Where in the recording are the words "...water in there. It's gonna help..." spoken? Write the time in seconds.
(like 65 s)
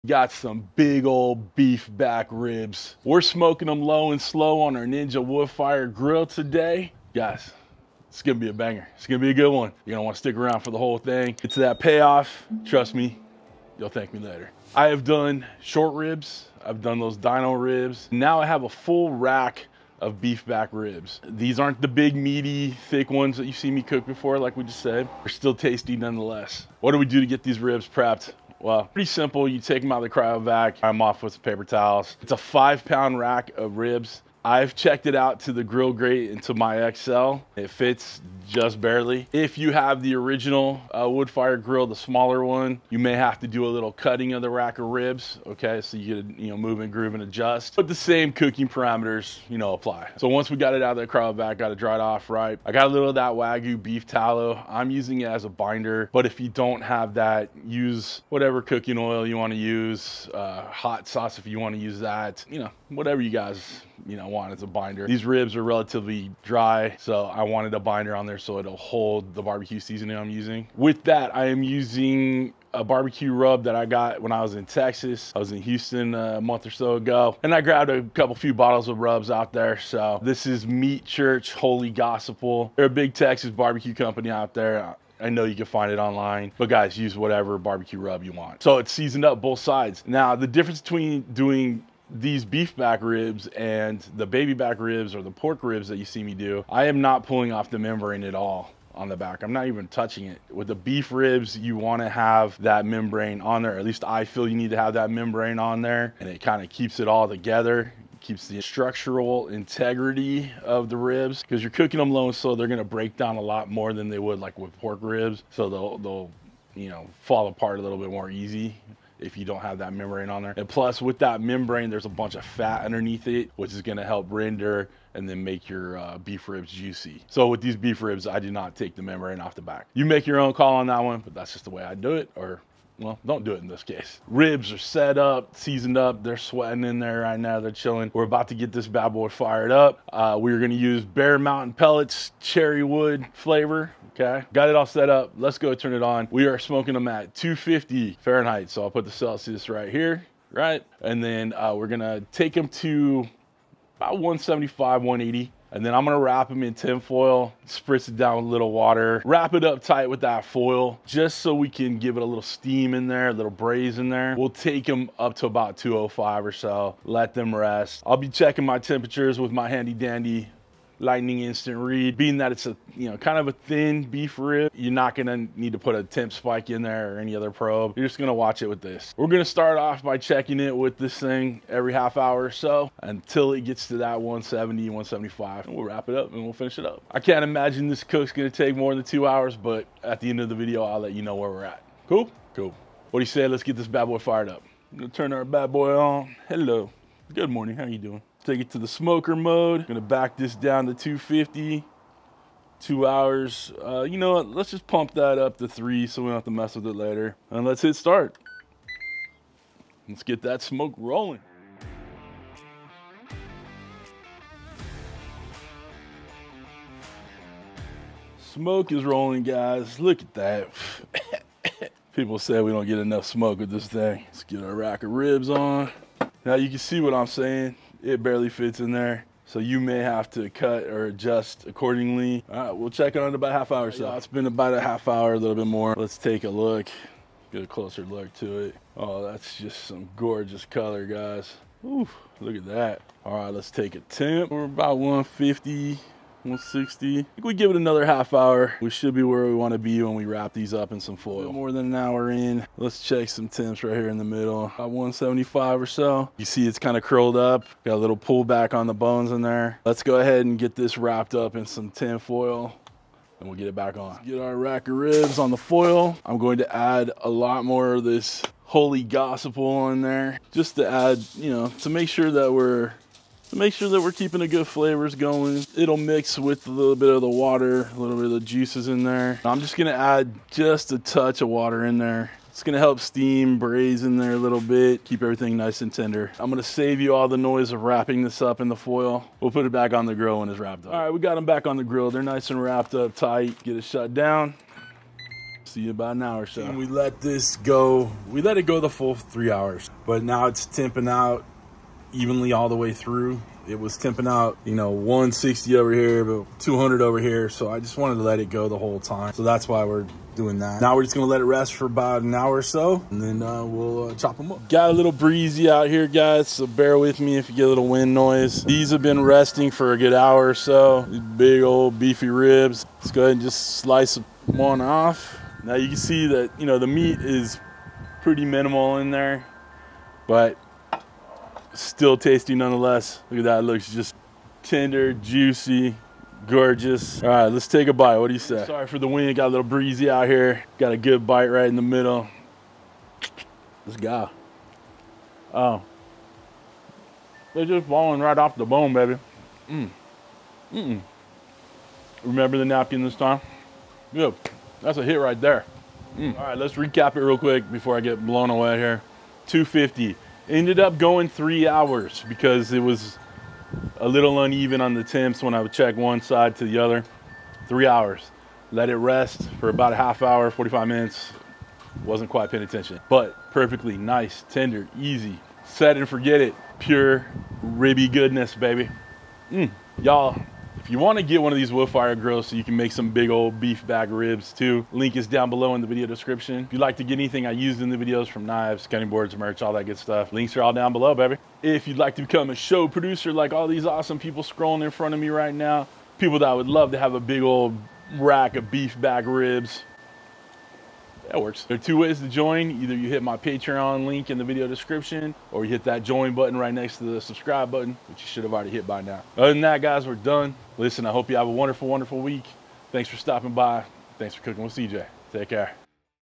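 281 s.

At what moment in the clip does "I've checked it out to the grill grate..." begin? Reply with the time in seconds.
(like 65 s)
34 s.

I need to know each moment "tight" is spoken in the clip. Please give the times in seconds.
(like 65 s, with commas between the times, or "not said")
159 s, 293 s.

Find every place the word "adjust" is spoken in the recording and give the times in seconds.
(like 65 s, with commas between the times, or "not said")
47 s, 231 s.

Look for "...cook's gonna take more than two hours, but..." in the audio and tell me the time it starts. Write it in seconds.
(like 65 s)
188 s.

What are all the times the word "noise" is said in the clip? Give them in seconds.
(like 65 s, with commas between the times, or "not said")
287 s, 318 s.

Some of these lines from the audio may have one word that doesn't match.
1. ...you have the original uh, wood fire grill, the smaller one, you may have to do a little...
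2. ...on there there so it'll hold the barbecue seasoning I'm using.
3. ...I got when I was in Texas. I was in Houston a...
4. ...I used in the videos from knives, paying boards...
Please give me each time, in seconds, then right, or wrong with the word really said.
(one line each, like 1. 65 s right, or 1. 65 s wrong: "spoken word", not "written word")
1. 39 s right
2. 68 s right
3. 73 s right
4. 387 s wrong: "cutting", not "paying".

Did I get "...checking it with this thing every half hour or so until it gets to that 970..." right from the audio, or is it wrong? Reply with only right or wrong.
wrong.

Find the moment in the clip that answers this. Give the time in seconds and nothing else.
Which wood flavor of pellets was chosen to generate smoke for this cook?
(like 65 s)
142 s.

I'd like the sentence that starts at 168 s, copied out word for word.
I'll be checking my temperatures with my handy dandy lightning instant read.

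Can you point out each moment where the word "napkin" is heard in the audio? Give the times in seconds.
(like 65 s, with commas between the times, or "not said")
352 s.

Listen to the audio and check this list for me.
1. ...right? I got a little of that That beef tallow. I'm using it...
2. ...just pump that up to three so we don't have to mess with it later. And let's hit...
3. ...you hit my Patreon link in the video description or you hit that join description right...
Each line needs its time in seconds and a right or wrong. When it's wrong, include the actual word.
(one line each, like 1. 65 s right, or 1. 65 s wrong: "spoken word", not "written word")
1. 52 s wrong: "Wagyu", not "That"
2. 204 s right
3. 402 s wrong: "button", not "description".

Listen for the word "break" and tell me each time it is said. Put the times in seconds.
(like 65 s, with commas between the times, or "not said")
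112 s.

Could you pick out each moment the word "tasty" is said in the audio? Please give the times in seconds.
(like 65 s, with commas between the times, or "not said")
25 s, 332 s.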